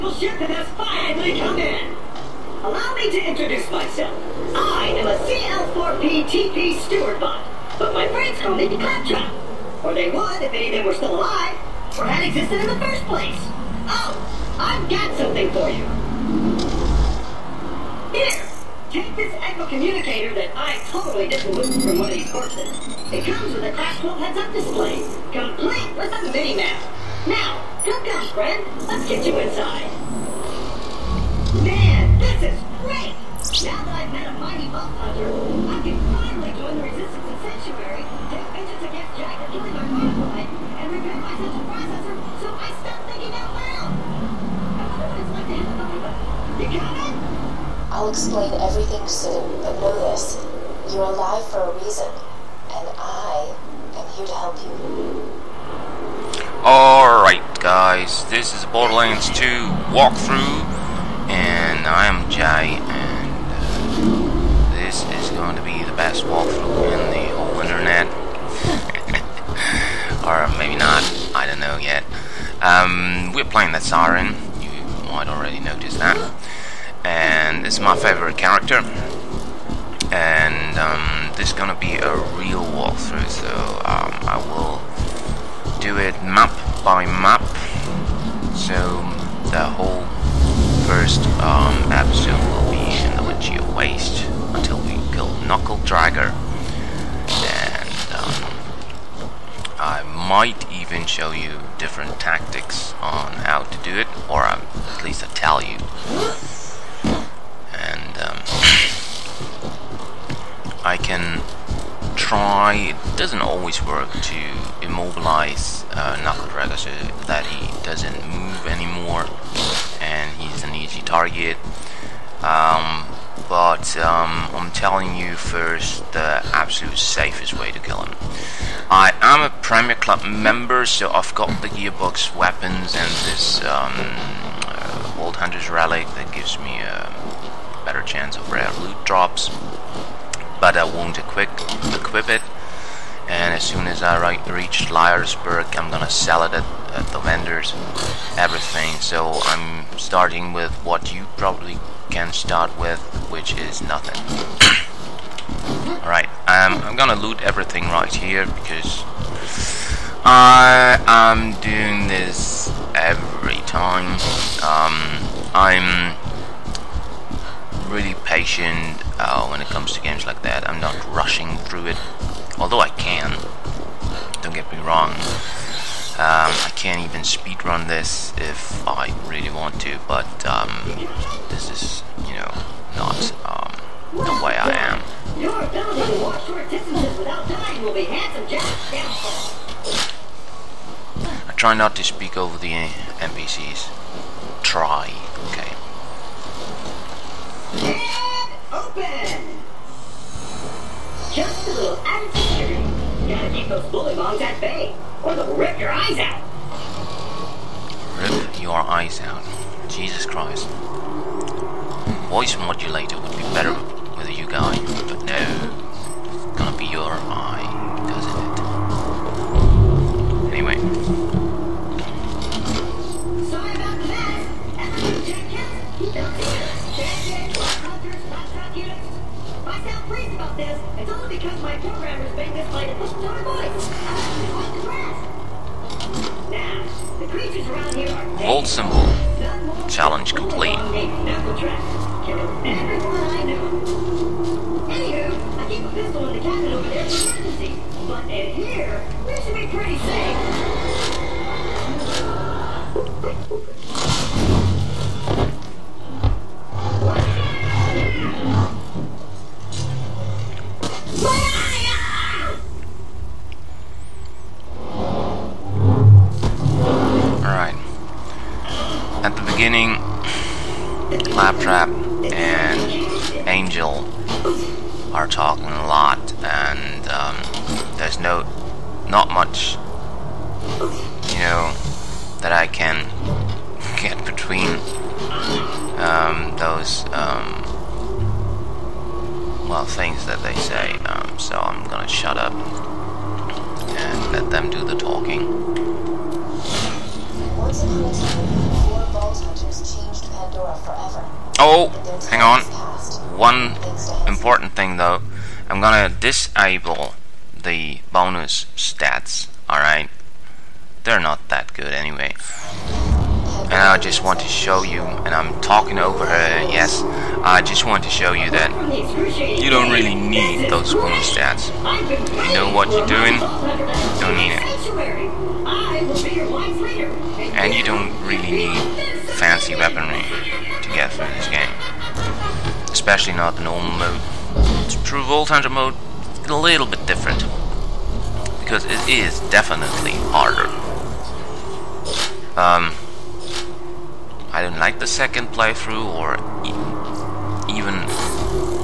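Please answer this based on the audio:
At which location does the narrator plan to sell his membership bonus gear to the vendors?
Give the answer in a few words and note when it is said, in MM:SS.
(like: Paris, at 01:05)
Liar's Berg, at 02:24.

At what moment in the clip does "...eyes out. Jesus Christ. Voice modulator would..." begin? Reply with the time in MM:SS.
03:28.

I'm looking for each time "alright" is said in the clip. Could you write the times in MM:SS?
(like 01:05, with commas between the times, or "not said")
00:56, 02:36, 05:09.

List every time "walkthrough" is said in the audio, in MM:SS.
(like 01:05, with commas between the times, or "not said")
00:59, 01:06, 01:22.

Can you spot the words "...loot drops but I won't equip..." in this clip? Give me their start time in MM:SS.
02:18.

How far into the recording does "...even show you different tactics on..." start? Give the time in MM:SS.
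01:40.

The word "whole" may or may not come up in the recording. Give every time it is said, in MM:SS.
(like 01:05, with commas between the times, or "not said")
01:07, 01:29.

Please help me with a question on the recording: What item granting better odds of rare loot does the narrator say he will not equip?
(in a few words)
Old Hunter's Relic.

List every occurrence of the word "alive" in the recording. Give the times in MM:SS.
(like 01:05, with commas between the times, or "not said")
00:11, 00:51.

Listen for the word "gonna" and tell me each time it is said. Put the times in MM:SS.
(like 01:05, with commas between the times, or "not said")
01:21, 02:25, 02:36, 04:51, 05:05.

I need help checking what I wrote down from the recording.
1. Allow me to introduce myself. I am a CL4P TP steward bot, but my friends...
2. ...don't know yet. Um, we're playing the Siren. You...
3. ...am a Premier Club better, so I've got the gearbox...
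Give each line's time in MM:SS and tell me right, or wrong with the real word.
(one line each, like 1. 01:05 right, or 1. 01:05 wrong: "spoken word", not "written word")
1. 00:02 right
2. 01:11 right
3. 02:09 wrong: "member", not "better".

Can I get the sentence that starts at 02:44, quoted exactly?
Um, I'm really patient uh, when it comes to games like that.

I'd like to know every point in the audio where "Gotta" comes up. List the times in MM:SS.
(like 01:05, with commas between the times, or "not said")
03:23.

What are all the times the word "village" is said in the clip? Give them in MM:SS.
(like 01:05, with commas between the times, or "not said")
not said.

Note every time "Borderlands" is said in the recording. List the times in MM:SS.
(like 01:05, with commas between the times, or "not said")
00:58.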